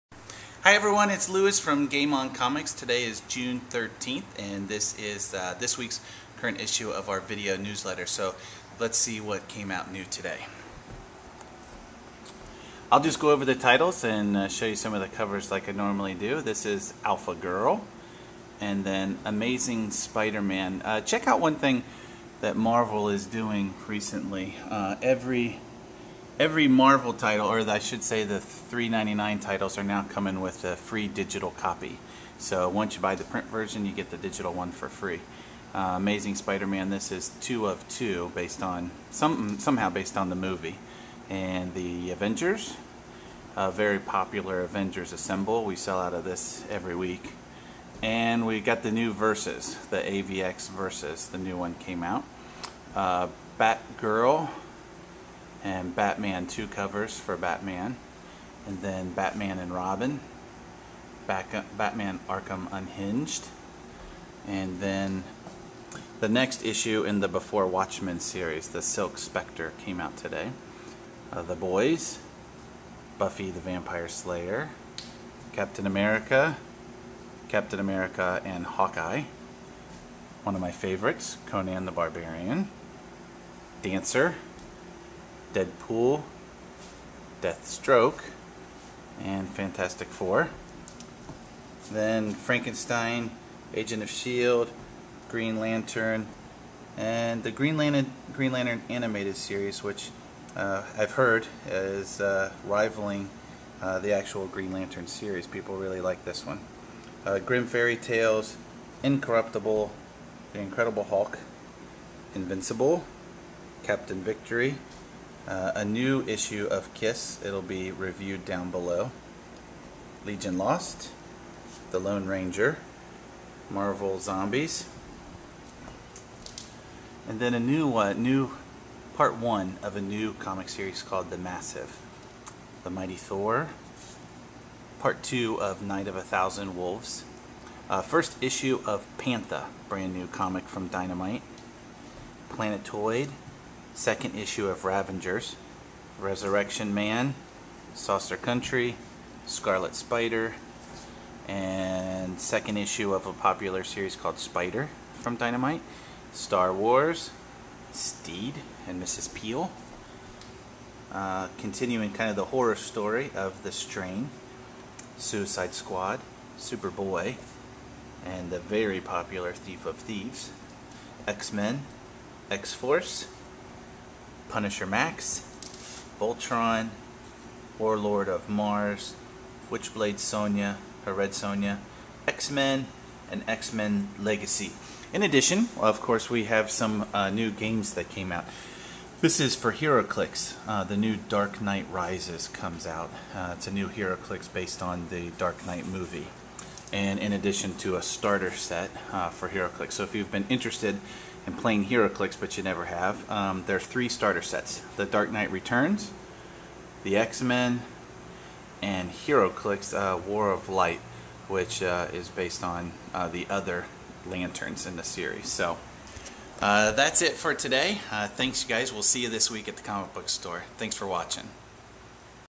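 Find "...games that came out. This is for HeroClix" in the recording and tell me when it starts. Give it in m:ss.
3:07.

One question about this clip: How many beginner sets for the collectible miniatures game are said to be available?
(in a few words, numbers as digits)
3.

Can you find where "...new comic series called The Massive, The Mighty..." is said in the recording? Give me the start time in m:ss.
2:10.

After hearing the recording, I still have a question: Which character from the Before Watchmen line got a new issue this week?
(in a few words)
Silk Spectre.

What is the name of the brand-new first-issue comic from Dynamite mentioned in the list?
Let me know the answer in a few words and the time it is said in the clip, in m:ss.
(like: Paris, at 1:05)
Pantha, at 2:19.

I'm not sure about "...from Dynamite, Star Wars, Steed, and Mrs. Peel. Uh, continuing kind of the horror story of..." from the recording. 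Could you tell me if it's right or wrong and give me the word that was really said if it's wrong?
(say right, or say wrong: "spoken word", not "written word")
right.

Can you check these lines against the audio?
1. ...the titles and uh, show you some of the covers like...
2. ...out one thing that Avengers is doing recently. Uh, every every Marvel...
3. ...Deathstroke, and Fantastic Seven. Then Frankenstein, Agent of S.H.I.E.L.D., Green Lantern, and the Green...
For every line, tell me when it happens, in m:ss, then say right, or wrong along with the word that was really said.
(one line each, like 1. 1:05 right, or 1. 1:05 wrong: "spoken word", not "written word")
1. 0:13 right
2. 0:21 wrong: "Marvel", not "Avengers"
3. 1:27 wrong: "Four", not "Seven".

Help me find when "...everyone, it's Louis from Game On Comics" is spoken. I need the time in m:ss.
0:00.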